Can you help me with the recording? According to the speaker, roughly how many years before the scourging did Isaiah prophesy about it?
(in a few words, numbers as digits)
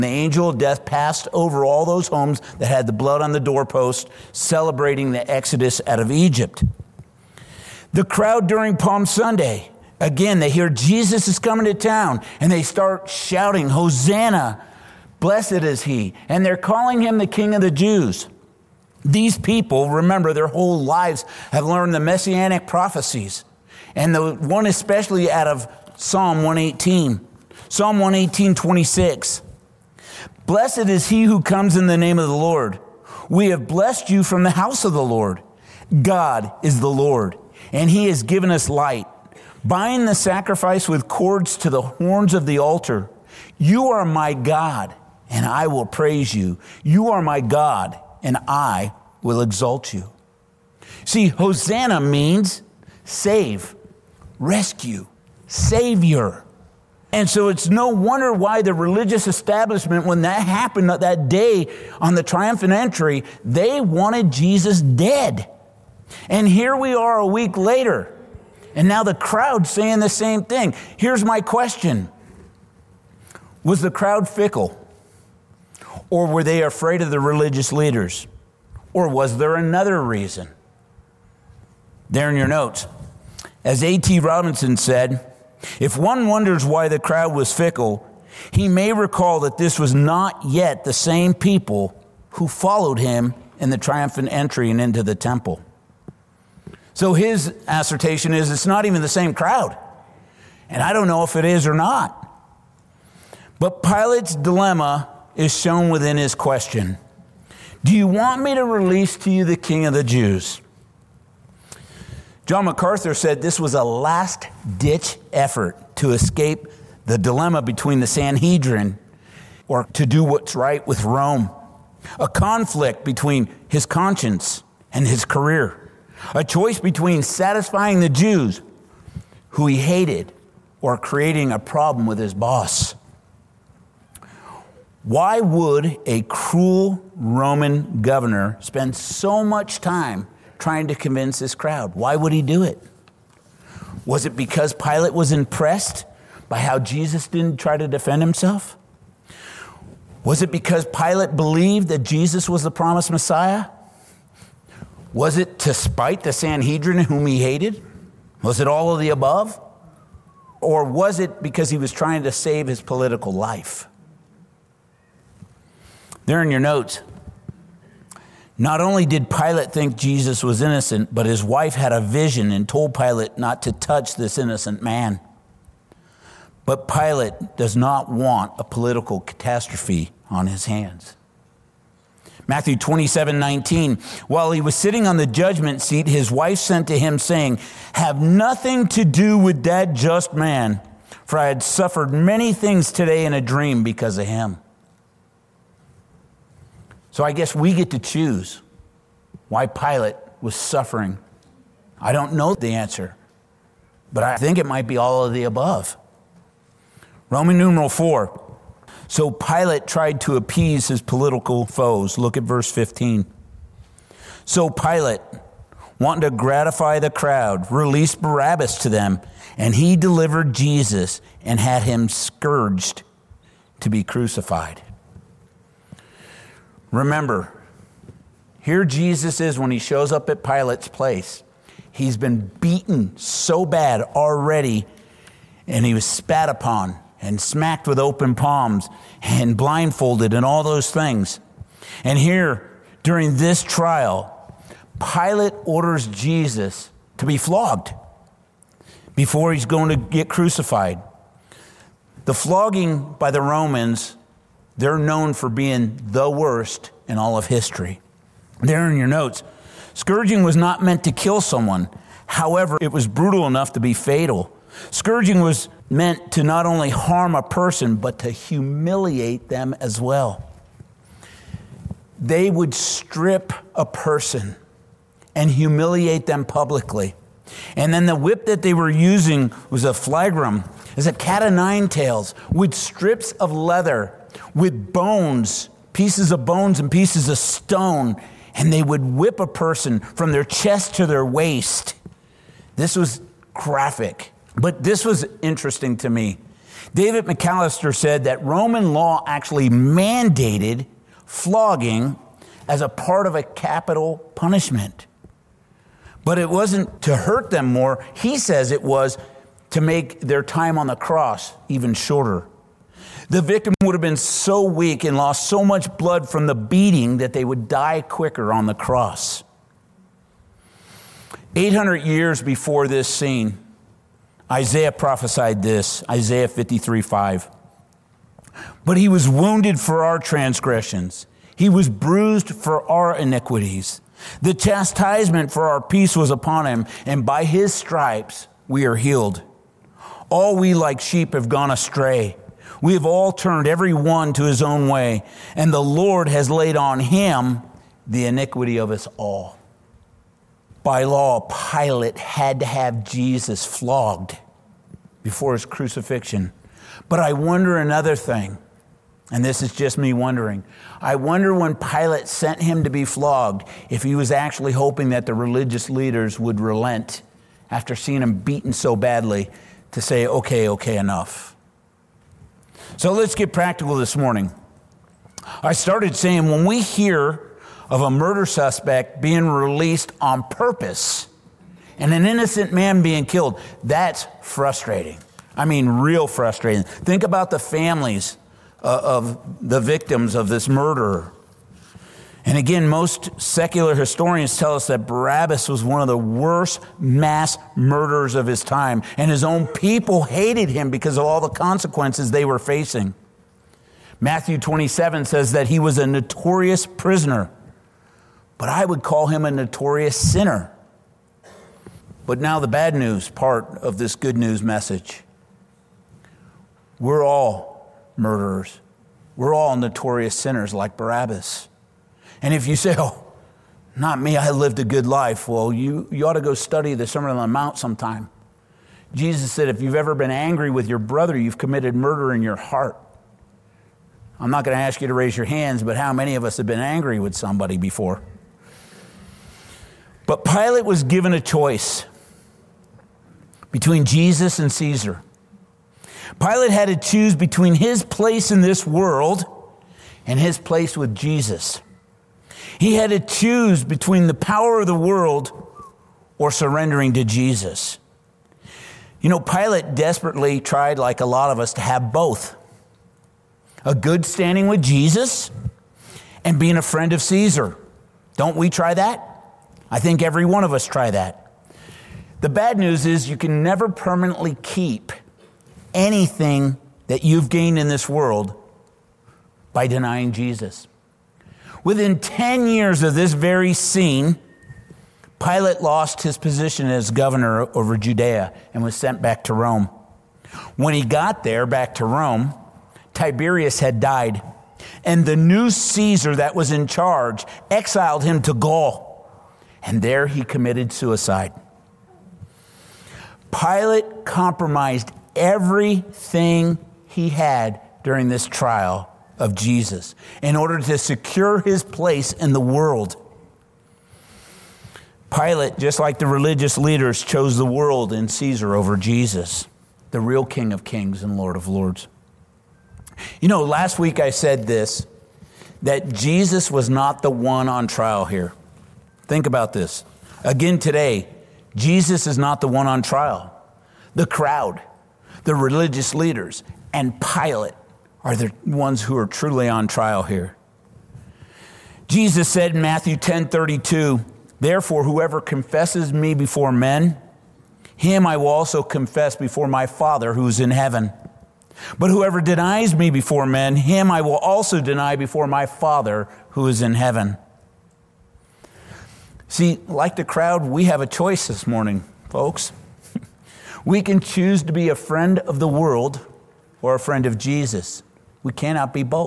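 800.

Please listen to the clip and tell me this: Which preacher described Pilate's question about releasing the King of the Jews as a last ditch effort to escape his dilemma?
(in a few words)
John MacArthur.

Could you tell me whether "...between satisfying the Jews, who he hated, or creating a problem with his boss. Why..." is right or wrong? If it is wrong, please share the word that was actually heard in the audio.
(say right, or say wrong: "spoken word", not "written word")
right.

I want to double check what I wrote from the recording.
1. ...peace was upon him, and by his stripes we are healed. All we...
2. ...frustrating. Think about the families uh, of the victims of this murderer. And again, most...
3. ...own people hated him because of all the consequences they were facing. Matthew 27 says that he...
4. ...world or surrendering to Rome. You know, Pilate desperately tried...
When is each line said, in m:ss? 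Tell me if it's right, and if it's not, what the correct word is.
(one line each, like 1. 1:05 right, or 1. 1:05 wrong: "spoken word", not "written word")
1. 5:35 right
2. 6:26 right
3. 6:39 right
4. 7:34 wrong: "Jesus", not "Rome".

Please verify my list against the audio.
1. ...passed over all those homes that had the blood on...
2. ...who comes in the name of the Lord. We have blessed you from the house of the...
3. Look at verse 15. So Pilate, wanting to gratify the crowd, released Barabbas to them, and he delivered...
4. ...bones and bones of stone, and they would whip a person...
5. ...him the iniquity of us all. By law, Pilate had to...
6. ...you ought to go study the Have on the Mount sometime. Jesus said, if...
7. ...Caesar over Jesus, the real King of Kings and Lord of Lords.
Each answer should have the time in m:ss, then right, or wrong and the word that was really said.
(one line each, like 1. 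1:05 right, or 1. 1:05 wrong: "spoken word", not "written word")
1. 0:00 right
2. 0:31 right
3. 3:32 right
4. 4:46 wrong: "pieces", not "bones"
5. 5:46 right
6. 7:06 wrong: "Sermon", not "Have"
7. 8:38 right.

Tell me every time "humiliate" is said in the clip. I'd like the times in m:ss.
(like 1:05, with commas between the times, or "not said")
4:28, 4:35.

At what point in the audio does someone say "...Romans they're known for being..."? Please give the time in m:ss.
4:13.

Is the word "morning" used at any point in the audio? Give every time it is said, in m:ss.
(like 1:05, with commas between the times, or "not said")
6:14, 9:21.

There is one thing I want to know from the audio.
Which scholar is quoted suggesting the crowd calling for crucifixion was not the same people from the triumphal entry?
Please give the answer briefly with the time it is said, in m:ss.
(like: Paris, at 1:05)
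A.T. Robertson, at 1:23.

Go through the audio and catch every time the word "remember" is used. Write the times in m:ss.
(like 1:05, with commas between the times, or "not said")
0:19, 3:46.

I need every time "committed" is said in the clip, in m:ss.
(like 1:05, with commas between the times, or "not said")
7:11, 8:20.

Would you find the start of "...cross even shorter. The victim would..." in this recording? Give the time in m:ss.
5:10.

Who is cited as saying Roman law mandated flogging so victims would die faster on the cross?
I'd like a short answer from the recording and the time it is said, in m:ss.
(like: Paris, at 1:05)
David McAllister, at 4:56.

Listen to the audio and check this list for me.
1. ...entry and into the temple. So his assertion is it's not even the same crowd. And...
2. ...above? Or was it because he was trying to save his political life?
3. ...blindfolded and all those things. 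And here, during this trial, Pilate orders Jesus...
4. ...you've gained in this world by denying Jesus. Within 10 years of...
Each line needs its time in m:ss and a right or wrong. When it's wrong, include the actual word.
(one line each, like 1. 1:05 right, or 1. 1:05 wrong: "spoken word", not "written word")
1. 1:34 right
2. 2:39 right
3. 3:59 right
4. 7:57 right.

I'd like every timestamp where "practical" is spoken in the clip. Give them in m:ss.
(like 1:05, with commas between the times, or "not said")
6:13.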